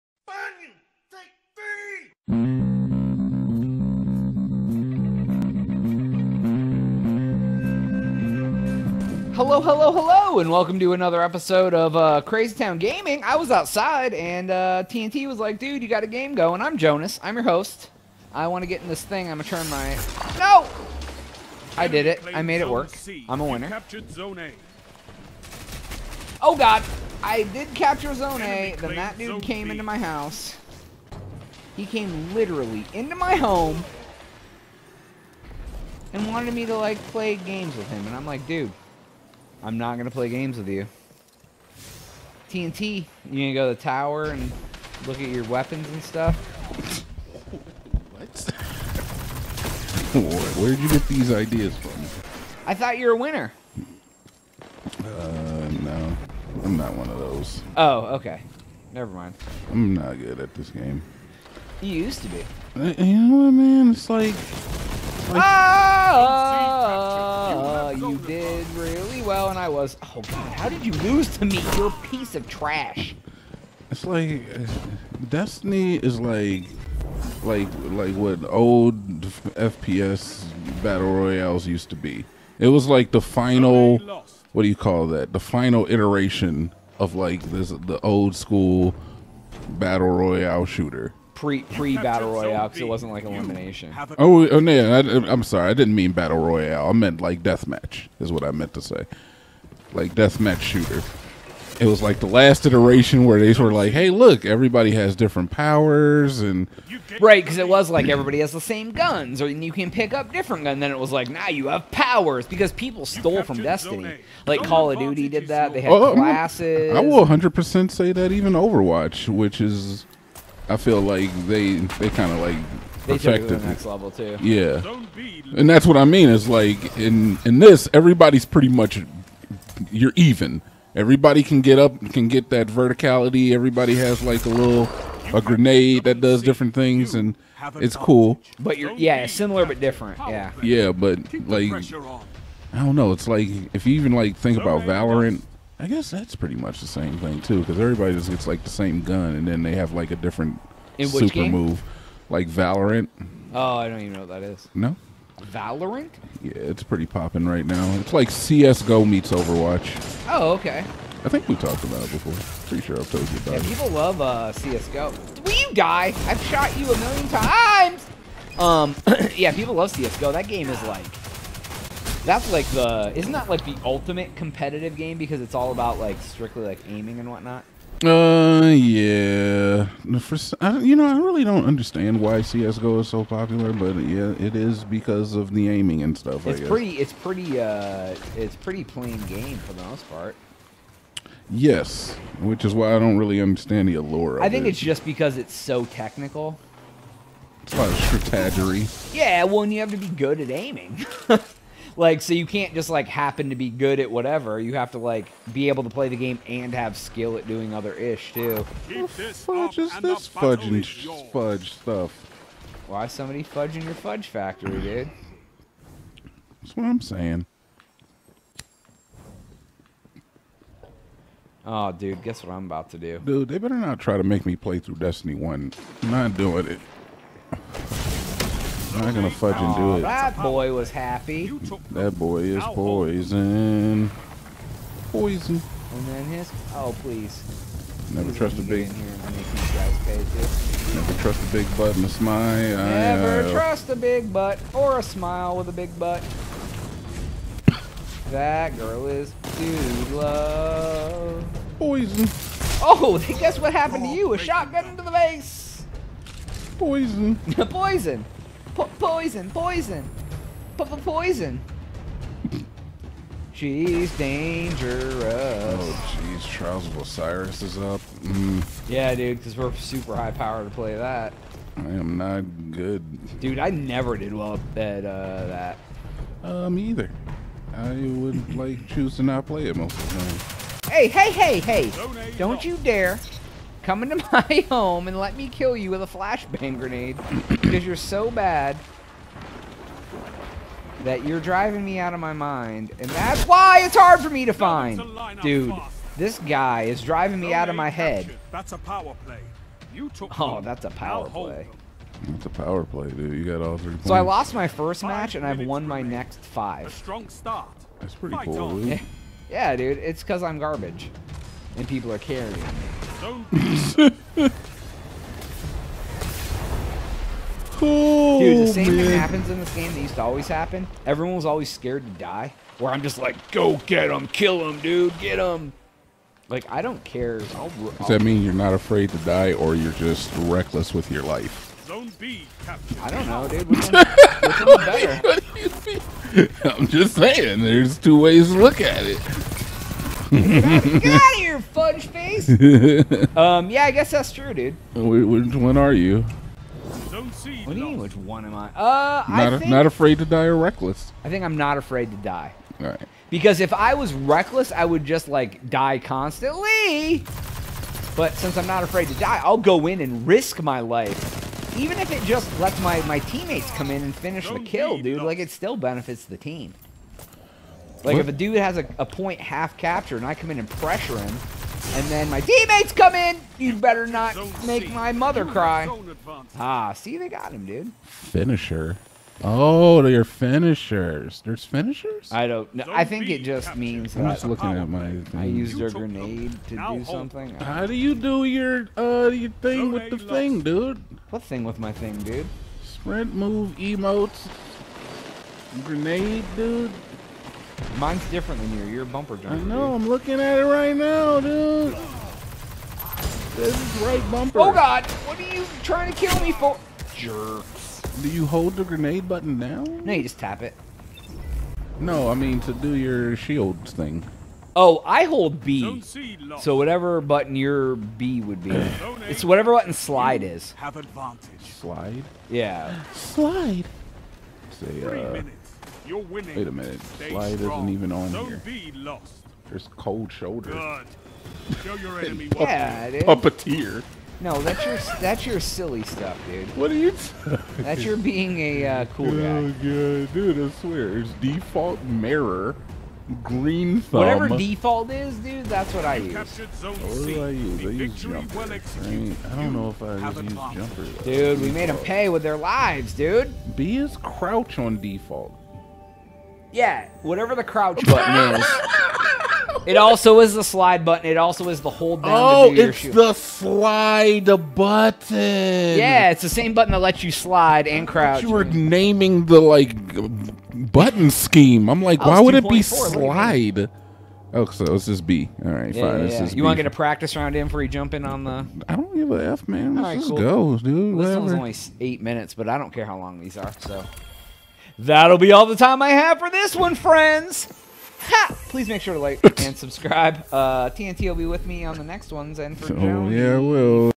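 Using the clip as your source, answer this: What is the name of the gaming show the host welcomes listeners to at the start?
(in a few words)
Crazy Town Gaming.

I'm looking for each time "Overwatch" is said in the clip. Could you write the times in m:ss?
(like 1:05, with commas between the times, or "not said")
1:58, 2:39.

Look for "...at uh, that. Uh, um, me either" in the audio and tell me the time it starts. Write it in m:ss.
4:34.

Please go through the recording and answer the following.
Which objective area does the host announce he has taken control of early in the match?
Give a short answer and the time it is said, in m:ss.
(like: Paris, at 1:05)
Zone A, at 0:28.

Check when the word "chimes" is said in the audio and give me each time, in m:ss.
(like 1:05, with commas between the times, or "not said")
not said.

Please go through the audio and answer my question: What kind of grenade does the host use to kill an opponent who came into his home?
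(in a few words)
flashbang grenade.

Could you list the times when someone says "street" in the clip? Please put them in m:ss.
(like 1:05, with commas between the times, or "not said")
not said.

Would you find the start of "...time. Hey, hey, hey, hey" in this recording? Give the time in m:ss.
4:40.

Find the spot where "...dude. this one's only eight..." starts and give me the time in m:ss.
8:00.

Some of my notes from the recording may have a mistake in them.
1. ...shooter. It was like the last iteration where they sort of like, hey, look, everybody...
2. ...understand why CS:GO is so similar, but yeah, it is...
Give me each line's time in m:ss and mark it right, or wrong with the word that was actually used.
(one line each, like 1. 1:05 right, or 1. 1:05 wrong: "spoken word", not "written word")
1. 1:40 right
2. 3:01 wrong: "popular", not "similar".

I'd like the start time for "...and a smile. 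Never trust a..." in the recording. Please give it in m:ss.
4:01.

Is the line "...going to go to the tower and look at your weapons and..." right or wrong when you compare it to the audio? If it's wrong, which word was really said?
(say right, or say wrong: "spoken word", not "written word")
right.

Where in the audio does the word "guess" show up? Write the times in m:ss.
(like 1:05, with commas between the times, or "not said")
2:25, 3:42, 4:13, 5:43.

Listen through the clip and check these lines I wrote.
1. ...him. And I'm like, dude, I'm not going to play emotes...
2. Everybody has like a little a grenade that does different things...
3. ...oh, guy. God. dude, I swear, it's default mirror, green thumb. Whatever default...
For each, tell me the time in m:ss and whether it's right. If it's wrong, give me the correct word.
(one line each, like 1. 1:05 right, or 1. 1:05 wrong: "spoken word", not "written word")
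1. 0:37 wrong: "games", not "emotes"
2. 2:13 right
3. 7:19 right.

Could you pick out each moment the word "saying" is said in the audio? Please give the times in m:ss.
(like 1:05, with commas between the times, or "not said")
3:37, 5:37.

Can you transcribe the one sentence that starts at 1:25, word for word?
The final iteration of like this the old school battle royale shooter pre pre battle royale because it wasn't like elimination.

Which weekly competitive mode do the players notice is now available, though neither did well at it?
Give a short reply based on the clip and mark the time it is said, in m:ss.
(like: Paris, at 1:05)
Trials of Osiris, at 4:26.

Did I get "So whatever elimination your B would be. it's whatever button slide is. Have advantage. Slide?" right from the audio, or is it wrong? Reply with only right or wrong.
wrong.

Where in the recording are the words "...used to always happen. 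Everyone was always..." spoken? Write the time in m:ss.
5:19.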